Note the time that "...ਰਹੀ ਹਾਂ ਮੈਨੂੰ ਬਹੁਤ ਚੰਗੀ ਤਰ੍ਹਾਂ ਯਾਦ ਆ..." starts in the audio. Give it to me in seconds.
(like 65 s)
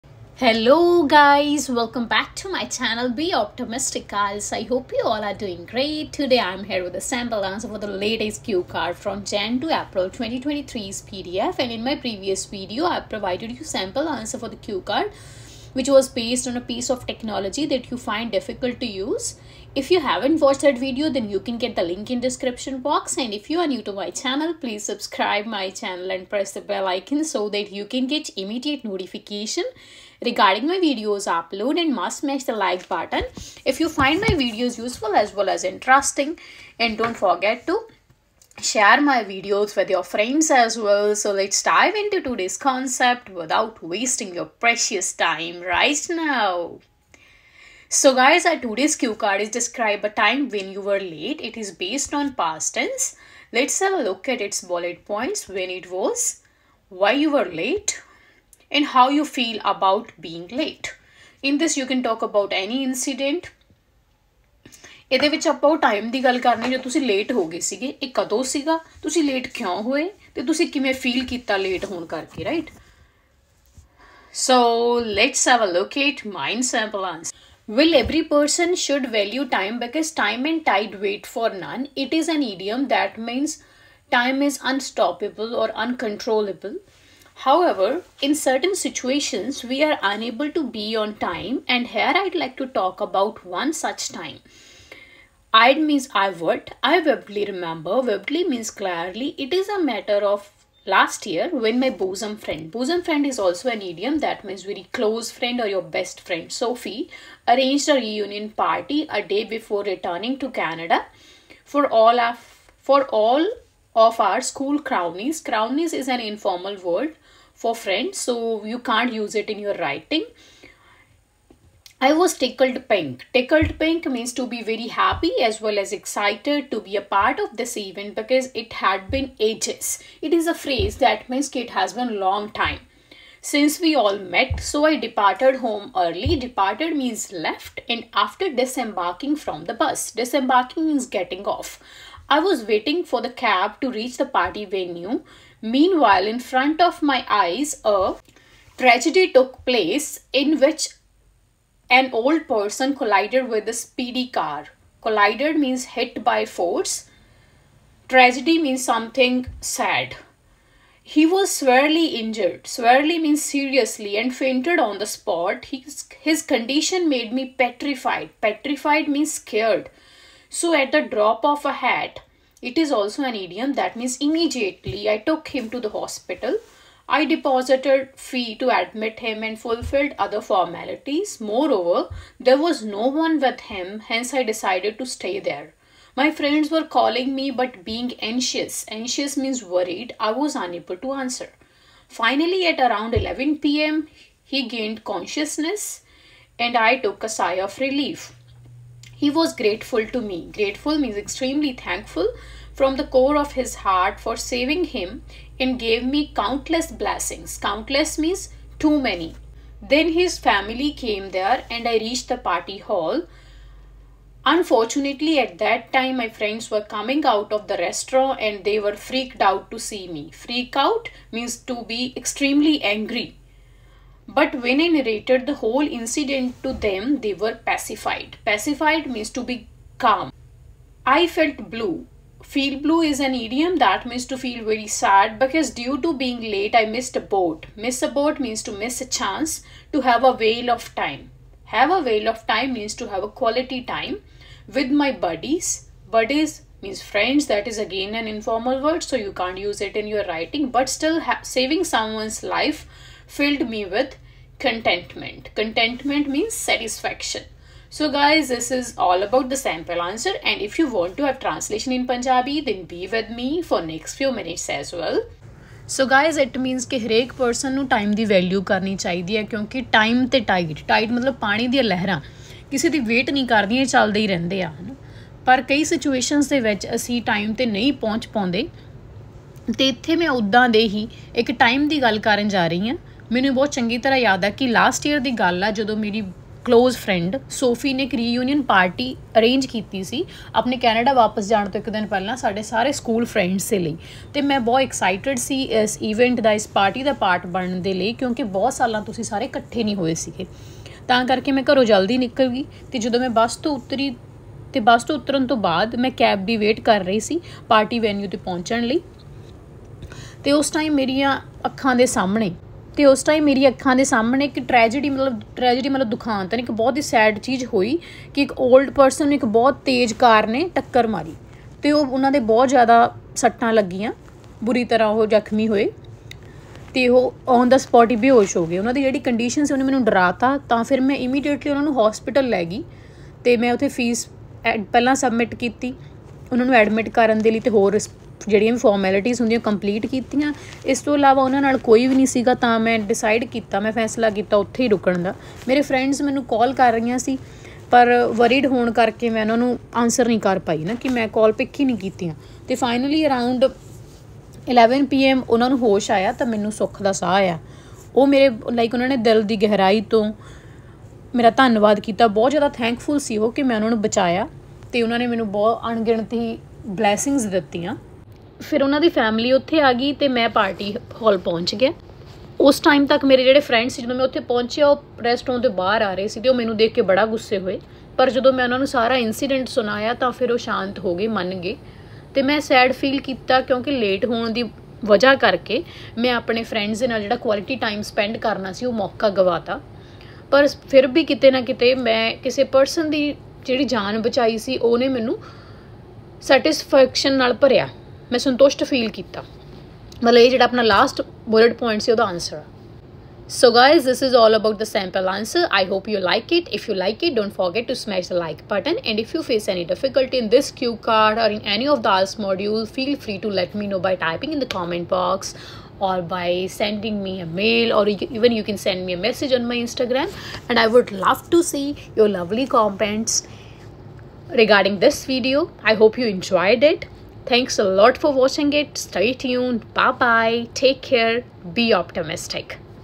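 282 s.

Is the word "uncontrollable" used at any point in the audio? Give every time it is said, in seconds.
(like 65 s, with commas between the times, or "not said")
85 s.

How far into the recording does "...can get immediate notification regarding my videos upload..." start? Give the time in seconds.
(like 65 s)
27 s.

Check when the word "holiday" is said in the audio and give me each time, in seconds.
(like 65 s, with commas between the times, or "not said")
not said.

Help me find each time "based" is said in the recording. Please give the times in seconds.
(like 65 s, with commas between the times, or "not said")
16 s, 51 s.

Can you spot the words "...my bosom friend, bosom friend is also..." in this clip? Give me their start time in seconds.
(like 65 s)
101 s.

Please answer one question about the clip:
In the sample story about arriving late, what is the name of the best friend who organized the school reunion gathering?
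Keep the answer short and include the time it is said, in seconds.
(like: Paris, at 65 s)
Sophie, at 106 s.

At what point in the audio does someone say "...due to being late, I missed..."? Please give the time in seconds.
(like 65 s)
235 s.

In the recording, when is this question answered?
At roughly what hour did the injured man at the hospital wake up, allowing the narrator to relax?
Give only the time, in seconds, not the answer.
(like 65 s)
193 s.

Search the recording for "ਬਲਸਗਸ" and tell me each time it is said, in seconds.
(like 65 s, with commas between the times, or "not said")
366 s.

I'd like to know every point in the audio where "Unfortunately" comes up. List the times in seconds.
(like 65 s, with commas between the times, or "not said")
214 s.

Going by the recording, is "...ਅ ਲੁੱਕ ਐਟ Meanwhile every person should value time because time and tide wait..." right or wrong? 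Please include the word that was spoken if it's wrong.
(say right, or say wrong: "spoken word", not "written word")
wrong: "Will", not "Meanwhile".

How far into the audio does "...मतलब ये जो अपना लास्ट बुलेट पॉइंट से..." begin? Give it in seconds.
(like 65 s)
400 s.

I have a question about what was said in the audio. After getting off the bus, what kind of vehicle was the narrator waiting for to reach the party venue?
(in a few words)
cab.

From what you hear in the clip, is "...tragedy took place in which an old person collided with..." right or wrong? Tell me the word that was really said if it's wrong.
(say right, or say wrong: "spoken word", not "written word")
right.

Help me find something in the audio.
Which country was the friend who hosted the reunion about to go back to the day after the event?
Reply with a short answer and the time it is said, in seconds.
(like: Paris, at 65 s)
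Canada, at 110 s.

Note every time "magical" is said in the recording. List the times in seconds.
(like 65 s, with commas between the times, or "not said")
not said.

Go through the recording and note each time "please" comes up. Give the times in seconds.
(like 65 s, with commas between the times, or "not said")
24 s.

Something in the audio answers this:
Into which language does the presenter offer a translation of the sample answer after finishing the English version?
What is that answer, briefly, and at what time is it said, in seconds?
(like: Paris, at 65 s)
Punjabi, at 262 s.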